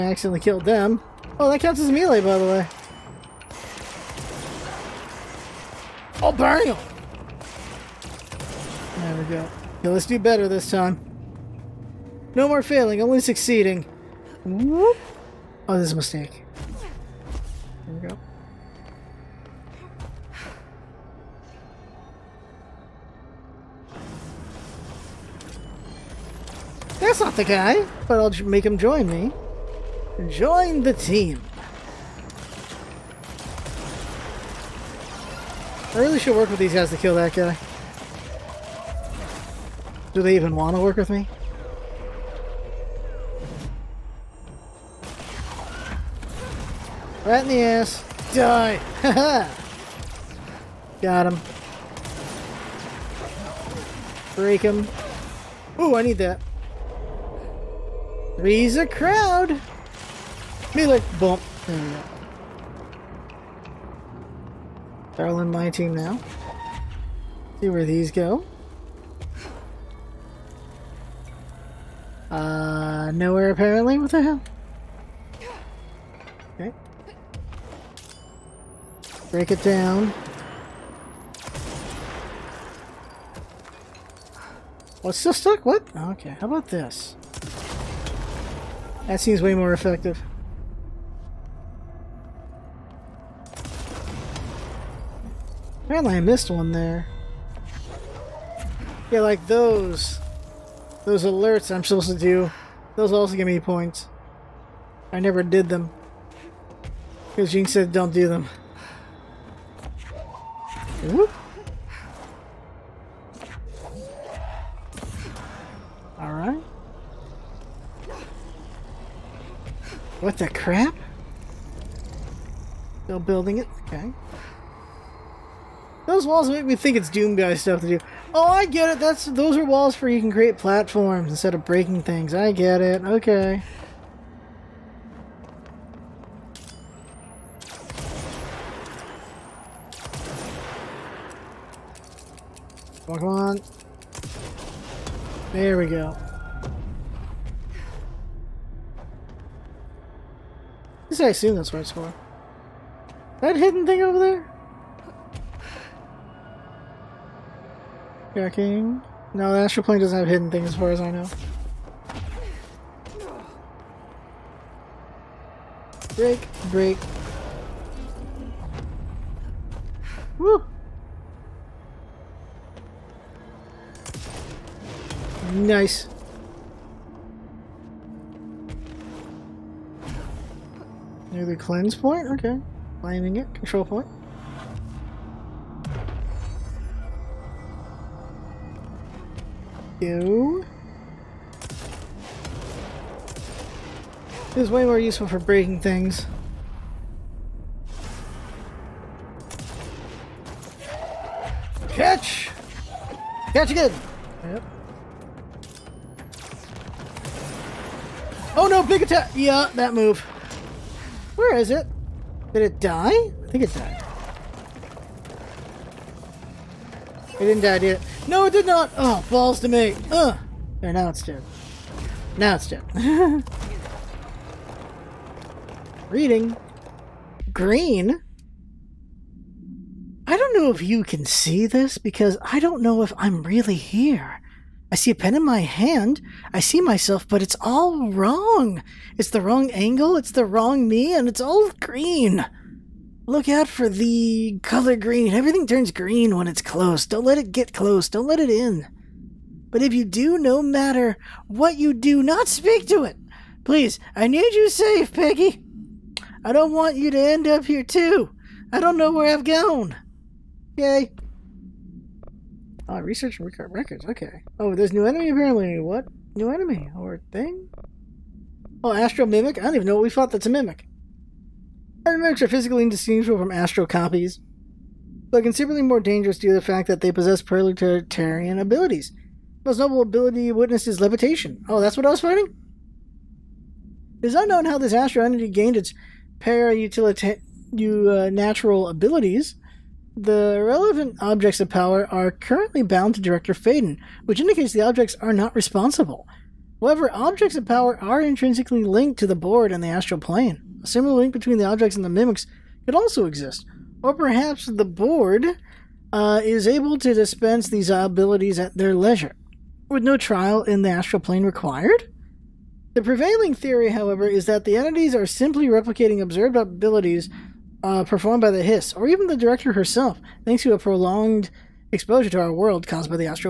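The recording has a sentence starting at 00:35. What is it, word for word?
I really should work with these guys to kill that guy.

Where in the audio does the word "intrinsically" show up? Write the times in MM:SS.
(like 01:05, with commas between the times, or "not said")
04:58.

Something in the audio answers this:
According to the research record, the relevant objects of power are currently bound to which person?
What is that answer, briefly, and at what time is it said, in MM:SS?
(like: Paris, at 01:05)
Director Faden, at 04:53.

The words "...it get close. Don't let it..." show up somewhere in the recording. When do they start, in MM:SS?
04:07.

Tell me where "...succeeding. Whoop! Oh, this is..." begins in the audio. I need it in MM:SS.
00:13.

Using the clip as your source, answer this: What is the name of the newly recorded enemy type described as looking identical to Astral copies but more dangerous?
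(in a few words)
Astral Mimic.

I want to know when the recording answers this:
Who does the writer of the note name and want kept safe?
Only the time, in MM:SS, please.
04:15.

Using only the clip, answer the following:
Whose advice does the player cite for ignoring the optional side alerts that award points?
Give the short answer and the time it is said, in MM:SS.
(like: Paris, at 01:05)
Jynx, at 01:47.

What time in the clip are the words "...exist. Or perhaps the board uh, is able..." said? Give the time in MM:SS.
05:03.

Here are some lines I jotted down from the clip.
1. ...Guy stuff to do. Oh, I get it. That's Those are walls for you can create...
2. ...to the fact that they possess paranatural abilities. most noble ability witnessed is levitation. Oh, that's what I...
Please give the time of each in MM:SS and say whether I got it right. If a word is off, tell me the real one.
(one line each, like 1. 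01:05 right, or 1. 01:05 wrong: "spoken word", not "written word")
1. 02:07 right
2. 04:36 right.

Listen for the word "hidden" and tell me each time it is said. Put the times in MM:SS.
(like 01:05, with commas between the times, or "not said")
02:33, 02:40.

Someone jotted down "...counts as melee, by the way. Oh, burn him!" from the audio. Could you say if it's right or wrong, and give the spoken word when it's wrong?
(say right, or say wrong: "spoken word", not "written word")
right.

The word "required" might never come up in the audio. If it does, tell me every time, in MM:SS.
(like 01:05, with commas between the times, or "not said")
05:11.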